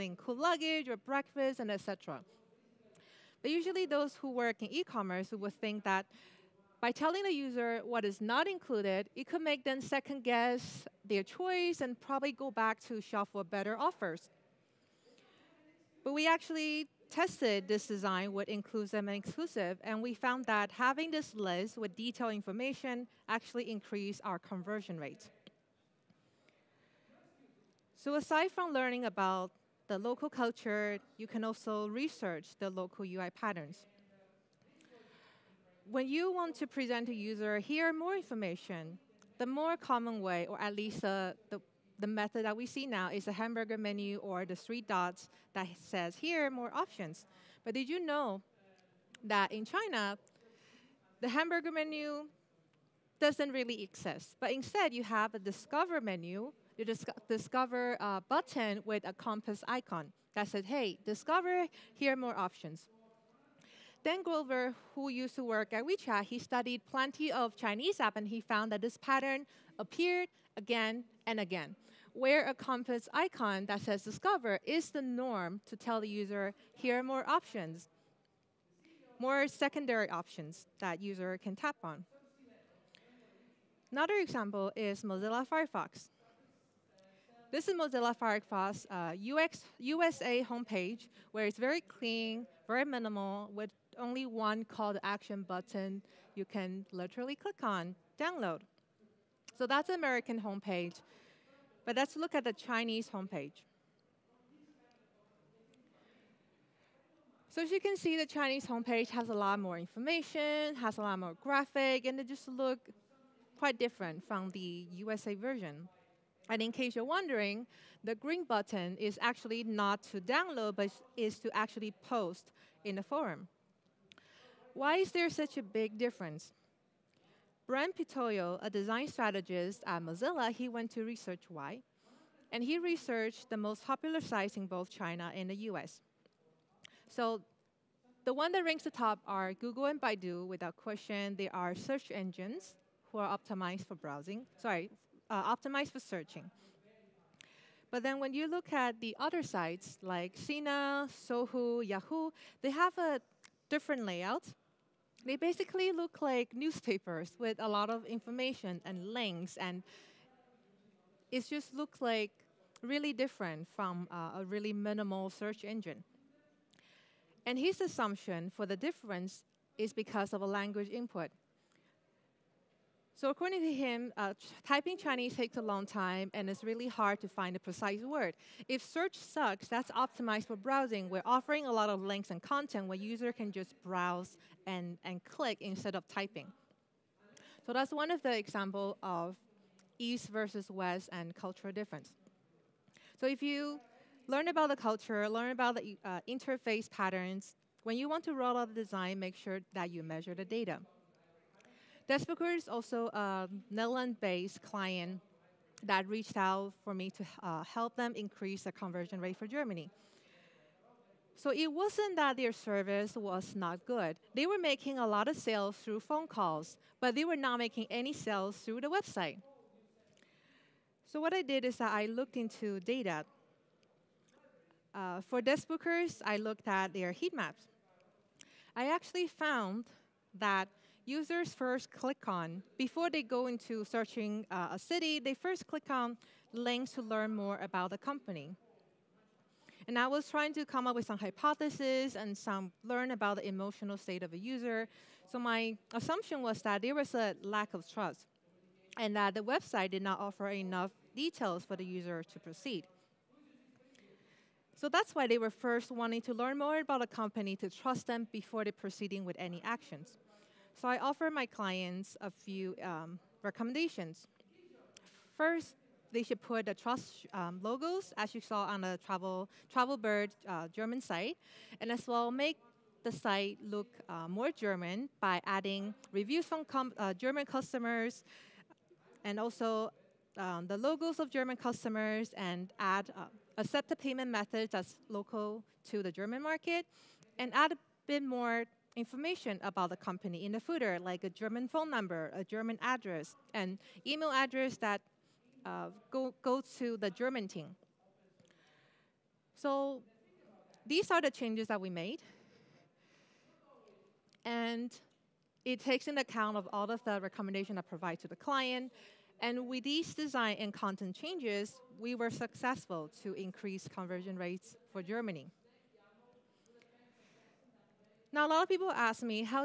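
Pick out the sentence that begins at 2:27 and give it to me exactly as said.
But then when you look at the other sites like Sina, Sohu, Yahoo, they have a different layout.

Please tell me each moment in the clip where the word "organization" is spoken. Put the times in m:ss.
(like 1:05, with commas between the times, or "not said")
not said.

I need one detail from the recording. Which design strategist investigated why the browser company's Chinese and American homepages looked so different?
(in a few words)
Brent Pitoyo.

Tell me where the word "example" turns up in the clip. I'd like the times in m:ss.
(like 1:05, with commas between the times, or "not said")
1:24, 3:08.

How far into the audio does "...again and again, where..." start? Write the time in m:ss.
1:10.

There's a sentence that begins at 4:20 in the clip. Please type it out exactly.
So I offer my clients a few um, recommendations.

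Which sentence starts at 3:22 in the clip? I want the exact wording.
Deskbookers is also a Netherlands-based client that reached out for me to uh, help them increase the conversion rate for Germany.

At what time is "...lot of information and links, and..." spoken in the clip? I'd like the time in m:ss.
2:37.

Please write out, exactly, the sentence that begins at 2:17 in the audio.
So the one that ranks the top are Google and Baidu, without question.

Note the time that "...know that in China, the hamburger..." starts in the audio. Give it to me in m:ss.
0:48.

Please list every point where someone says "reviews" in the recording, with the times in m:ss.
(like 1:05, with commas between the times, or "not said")
4:36.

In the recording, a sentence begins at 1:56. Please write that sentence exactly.
And in case you're wondering, the green button is actually not to download, but is to actually post in the forum.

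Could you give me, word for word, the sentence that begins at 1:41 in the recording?
But let's look at the Chinese homepage.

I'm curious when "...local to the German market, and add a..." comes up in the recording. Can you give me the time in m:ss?
4:45.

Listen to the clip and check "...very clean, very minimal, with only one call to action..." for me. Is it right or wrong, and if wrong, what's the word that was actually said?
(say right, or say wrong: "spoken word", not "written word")
right.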